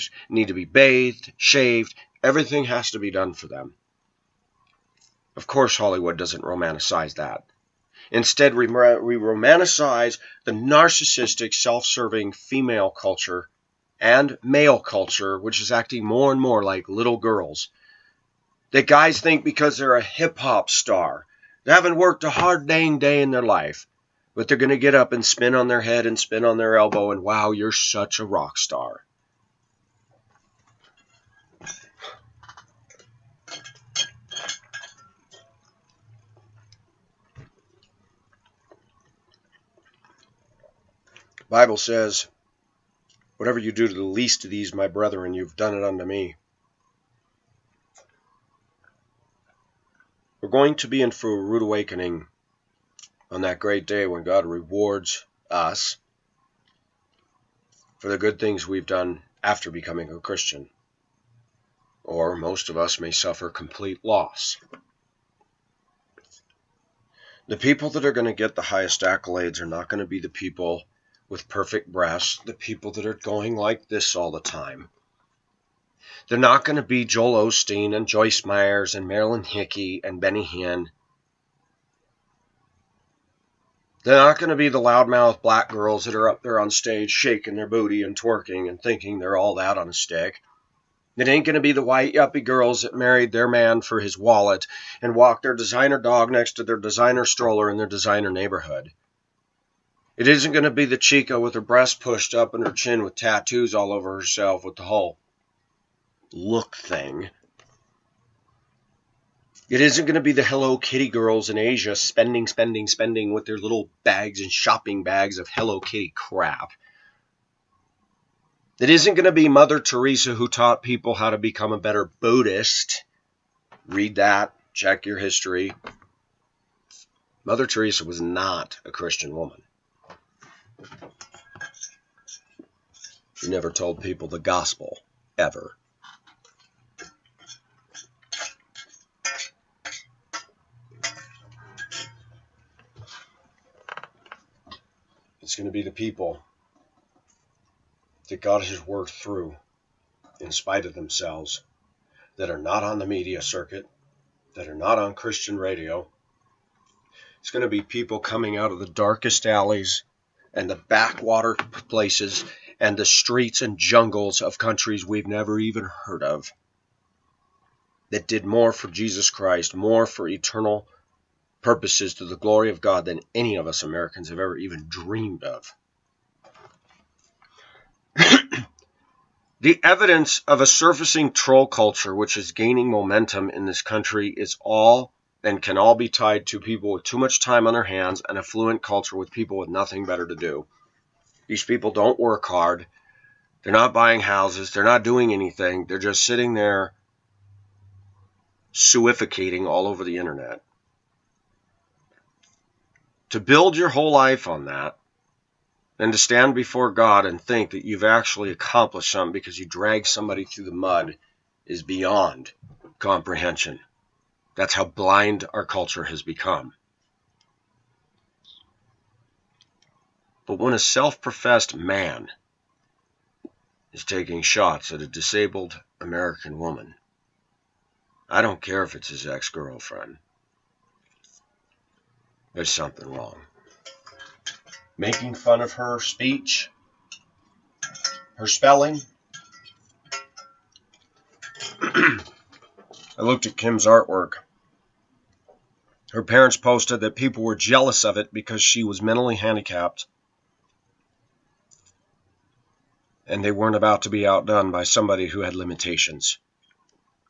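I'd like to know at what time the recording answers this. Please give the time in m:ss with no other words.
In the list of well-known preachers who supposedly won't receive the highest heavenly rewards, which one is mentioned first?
1:17.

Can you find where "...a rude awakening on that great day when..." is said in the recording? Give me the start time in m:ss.
0:51.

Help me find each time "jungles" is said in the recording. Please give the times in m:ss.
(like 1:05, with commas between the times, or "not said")
2:43.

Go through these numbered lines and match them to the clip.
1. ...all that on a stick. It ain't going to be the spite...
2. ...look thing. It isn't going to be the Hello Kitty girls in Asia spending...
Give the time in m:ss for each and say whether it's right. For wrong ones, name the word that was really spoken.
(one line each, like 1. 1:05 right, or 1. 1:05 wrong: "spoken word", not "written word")
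1. 1:29 wrong: "white", not "spite"
2. 1:46 right.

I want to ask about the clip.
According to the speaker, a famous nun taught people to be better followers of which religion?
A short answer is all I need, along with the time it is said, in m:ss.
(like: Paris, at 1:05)
Buddhist, at 2:02.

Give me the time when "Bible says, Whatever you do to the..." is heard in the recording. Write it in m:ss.
0:41.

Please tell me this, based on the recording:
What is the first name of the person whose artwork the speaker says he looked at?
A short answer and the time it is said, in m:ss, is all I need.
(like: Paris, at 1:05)
Kim, at 4:03.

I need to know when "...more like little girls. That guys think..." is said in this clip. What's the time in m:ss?
0:16.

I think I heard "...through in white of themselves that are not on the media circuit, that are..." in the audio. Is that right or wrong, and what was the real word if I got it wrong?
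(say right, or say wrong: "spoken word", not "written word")
wrong: "spite", not "white".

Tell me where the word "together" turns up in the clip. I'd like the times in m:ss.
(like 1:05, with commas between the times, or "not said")
not said.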